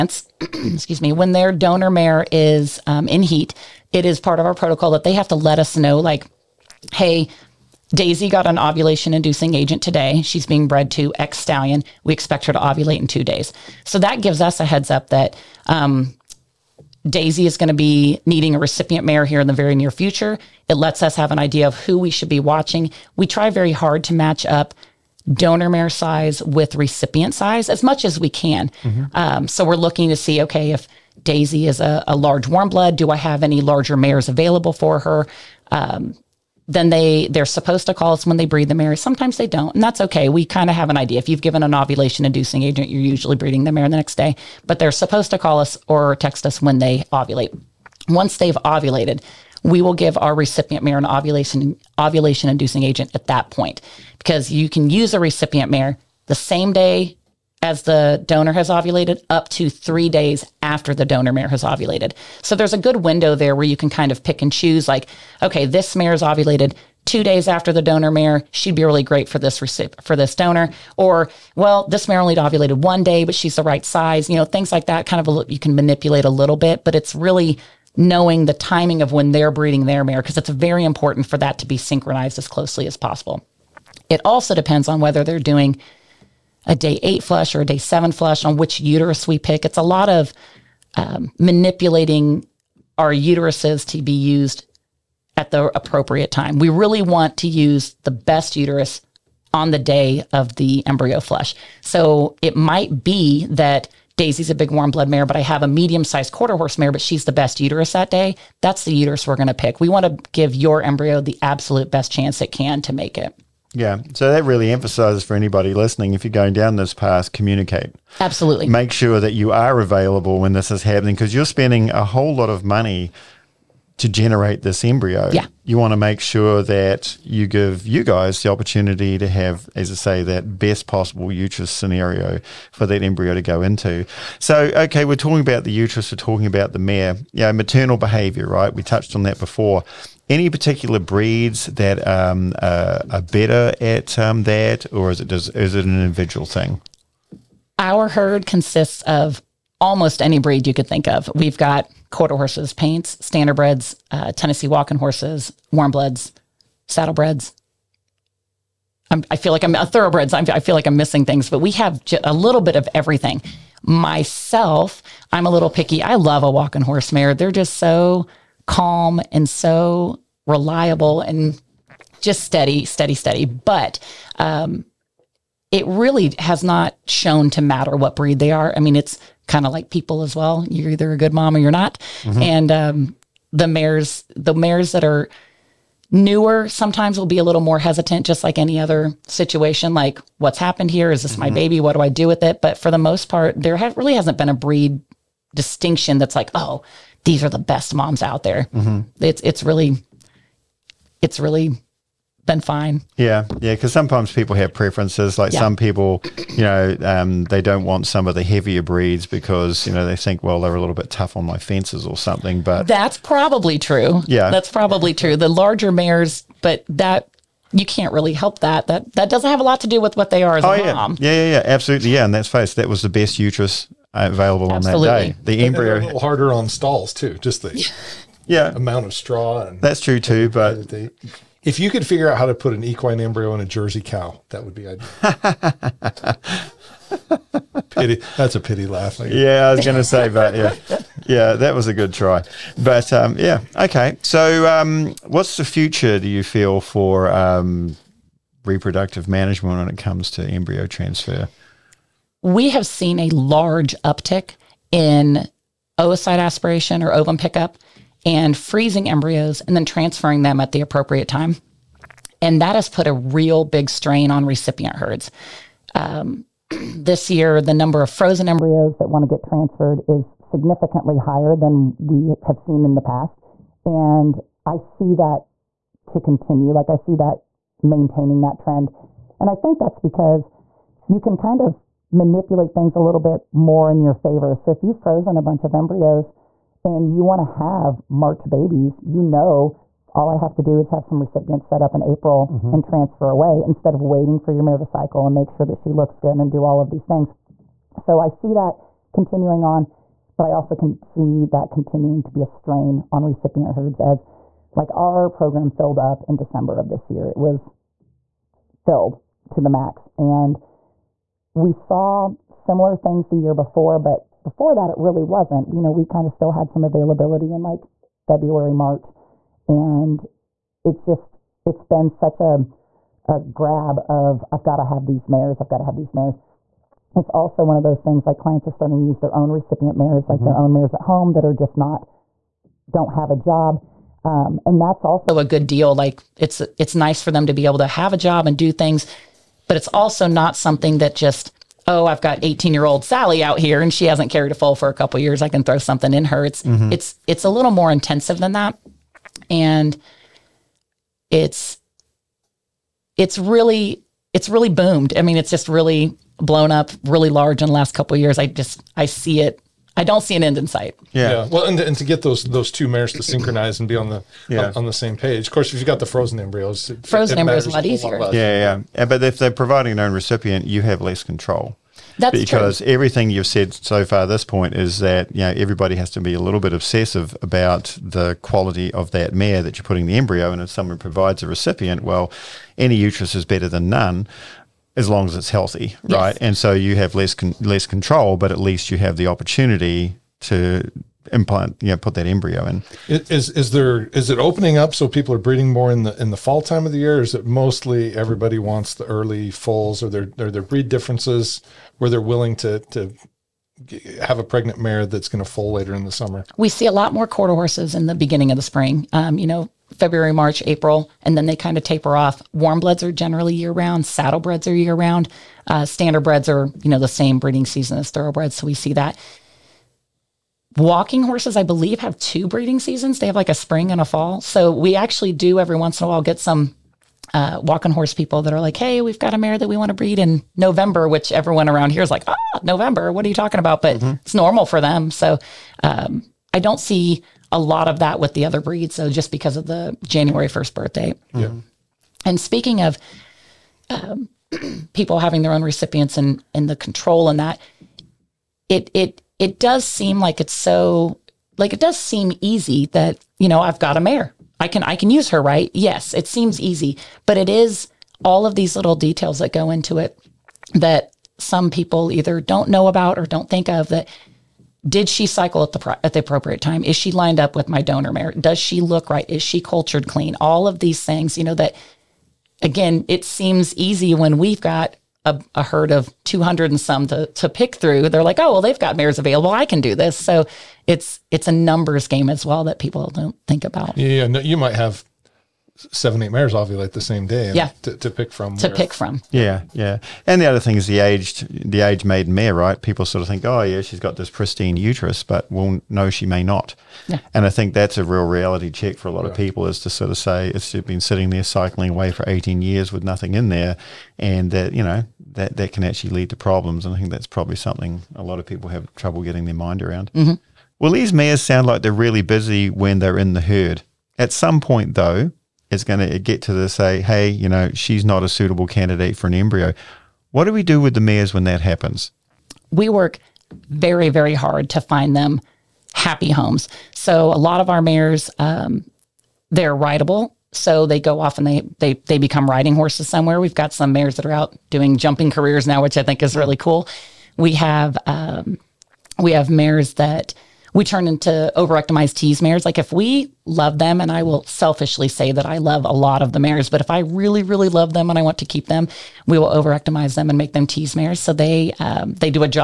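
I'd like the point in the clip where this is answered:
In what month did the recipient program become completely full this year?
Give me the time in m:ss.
5:06.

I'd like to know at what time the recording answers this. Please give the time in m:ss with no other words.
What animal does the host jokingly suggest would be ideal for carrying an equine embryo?
3:53.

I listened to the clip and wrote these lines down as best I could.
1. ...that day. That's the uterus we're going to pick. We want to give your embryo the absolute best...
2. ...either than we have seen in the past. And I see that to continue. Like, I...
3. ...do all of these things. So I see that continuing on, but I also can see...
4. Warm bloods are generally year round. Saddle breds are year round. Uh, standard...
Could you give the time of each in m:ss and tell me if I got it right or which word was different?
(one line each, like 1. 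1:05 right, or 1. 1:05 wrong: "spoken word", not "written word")
1. 1:47 right
2. 4:31 wrong: "higher", not "either"
3. 4:56 right
4. 6:52 right.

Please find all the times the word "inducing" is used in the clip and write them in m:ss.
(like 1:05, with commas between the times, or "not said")
0:09, 0:42, 0:52.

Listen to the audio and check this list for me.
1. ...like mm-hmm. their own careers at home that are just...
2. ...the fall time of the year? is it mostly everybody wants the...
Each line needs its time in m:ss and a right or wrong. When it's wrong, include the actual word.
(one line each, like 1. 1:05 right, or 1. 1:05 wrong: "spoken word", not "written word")
1. 5:30 wrong: "mayors", not "careers"
2. 6:36 right.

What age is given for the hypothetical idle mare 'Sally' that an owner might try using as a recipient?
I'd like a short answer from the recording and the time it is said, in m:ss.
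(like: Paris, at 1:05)
18, at 5:42.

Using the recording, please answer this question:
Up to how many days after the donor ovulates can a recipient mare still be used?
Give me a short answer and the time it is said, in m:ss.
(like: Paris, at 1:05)
3 days, at 0:59.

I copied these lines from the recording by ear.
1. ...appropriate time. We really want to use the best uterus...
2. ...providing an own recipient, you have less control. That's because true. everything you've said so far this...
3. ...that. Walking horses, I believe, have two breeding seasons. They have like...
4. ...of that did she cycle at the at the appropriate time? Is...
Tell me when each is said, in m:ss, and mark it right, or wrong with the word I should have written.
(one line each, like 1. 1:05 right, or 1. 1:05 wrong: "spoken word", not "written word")
1. 1:35 right
2. 6:09 right
3. 6:58 right
4. 7:43 right.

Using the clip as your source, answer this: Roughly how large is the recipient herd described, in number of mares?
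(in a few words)
200 and some.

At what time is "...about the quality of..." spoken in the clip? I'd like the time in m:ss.
6:17.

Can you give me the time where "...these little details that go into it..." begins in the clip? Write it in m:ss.
7:38.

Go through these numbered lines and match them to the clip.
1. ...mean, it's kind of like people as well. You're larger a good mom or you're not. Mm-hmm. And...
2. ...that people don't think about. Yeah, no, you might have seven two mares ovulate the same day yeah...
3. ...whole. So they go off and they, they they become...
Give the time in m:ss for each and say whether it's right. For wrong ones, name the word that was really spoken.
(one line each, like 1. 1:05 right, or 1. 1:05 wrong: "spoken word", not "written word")
1. 2:58 wrong: "either", not "larger"
2. 8:02 wrong: "eight", not "two"
3. 8:49 wrong: "rideable", not "whole".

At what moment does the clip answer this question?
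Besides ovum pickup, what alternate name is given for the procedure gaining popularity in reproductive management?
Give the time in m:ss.
4:15.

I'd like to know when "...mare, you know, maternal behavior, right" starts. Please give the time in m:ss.
2:16.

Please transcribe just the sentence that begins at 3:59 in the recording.
yeah, I was going to say, but yeah, yeah, that was a good try.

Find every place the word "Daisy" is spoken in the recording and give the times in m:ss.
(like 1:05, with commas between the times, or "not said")
0:07, 0:17, 0:31, 1:44.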